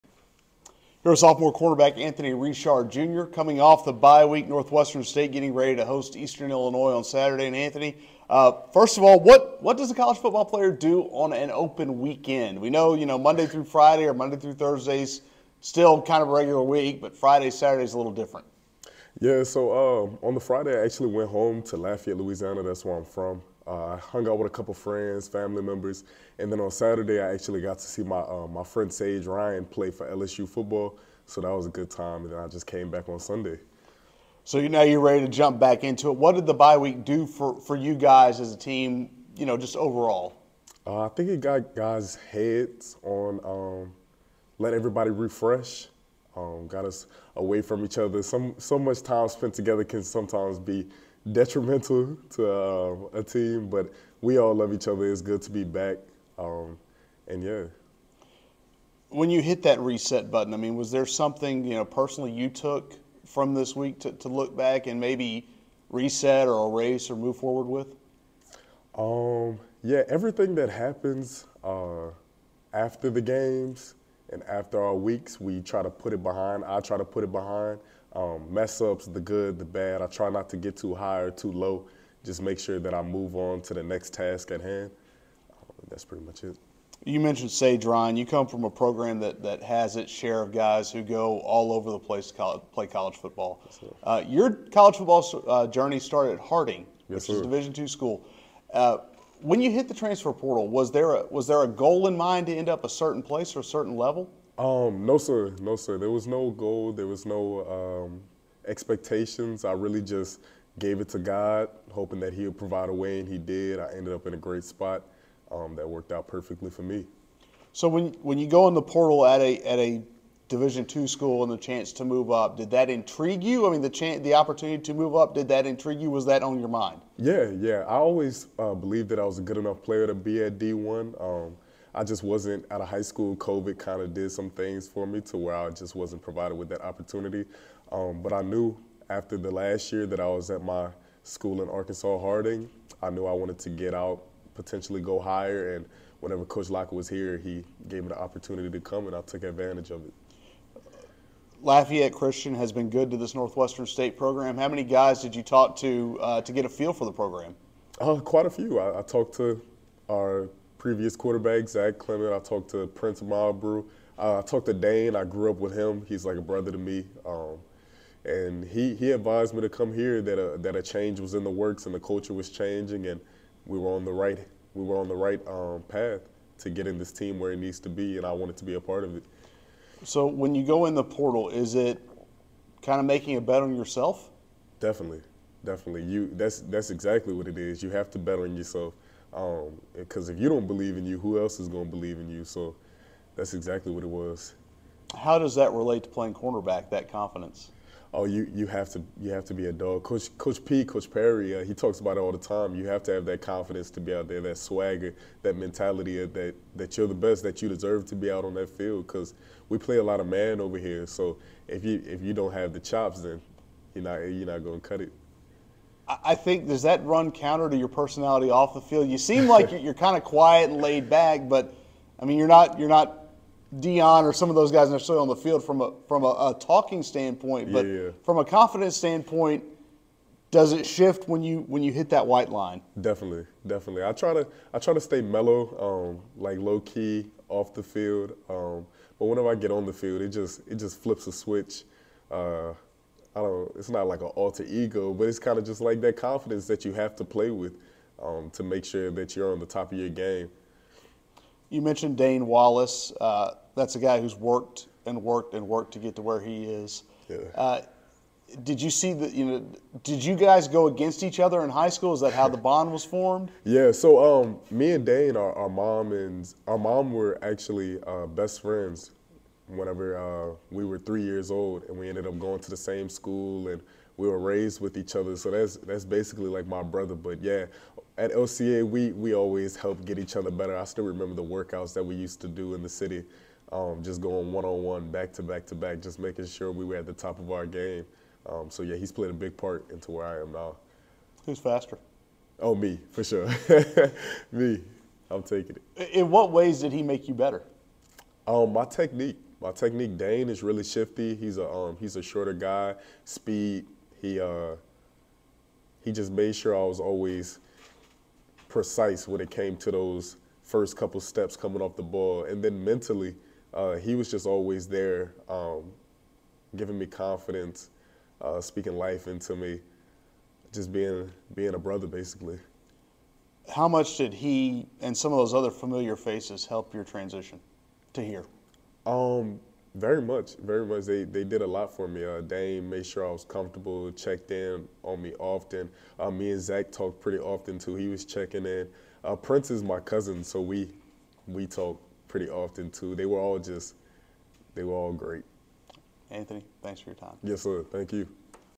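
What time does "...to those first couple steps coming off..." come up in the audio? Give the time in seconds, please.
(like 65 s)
309 s.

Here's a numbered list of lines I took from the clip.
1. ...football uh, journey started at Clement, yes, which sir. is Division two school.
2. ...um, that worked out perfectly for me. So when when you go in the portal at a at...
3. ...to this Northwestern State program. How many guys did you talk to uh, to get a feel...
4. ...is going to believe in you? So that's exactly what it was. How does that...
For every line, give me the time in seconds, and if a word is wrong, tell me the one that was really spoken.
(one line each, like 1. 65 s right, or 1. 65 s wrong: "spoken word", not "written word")
1. 94 s wrong: "Harding", not "Clement"
2. 115 s right
3. 153 s right
4. 191 s right.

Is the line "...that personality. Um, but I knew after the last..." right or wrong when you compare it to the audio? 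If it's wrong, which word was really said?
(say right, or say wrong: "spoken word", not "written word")
wrong: "opportunity", not "personality".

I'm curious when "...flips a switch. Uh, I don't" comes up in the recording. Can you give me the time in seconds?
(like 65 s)
240 s.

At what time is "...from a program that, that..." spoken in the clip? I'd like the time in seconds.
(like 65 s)
88 s.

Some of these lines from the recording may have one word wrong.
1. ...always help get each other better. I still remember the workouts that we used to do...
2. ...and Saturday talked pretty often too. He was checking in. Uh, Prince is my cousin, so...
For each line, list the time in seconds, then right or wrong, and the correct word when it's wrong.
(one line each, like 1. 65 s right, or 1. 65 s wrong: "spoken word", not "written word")
1. 279 s right
2. 336 s wrong: "Zach", not "Saturday".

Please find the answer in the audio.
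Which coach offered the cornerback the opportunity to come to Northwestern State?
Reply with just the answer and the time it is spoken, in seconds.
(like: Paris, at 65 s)
Coach Locker, at 146 s.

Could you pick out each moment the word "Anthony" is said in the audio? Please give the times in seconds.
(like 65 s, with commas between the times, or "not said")
1 s, 7 s, 346 s.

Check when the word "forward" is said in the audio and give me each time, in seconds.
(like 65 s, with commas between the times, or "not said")
67 s.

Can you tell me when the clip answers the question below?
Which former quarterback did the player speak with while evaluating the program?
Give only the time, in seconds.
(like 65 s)
161 s.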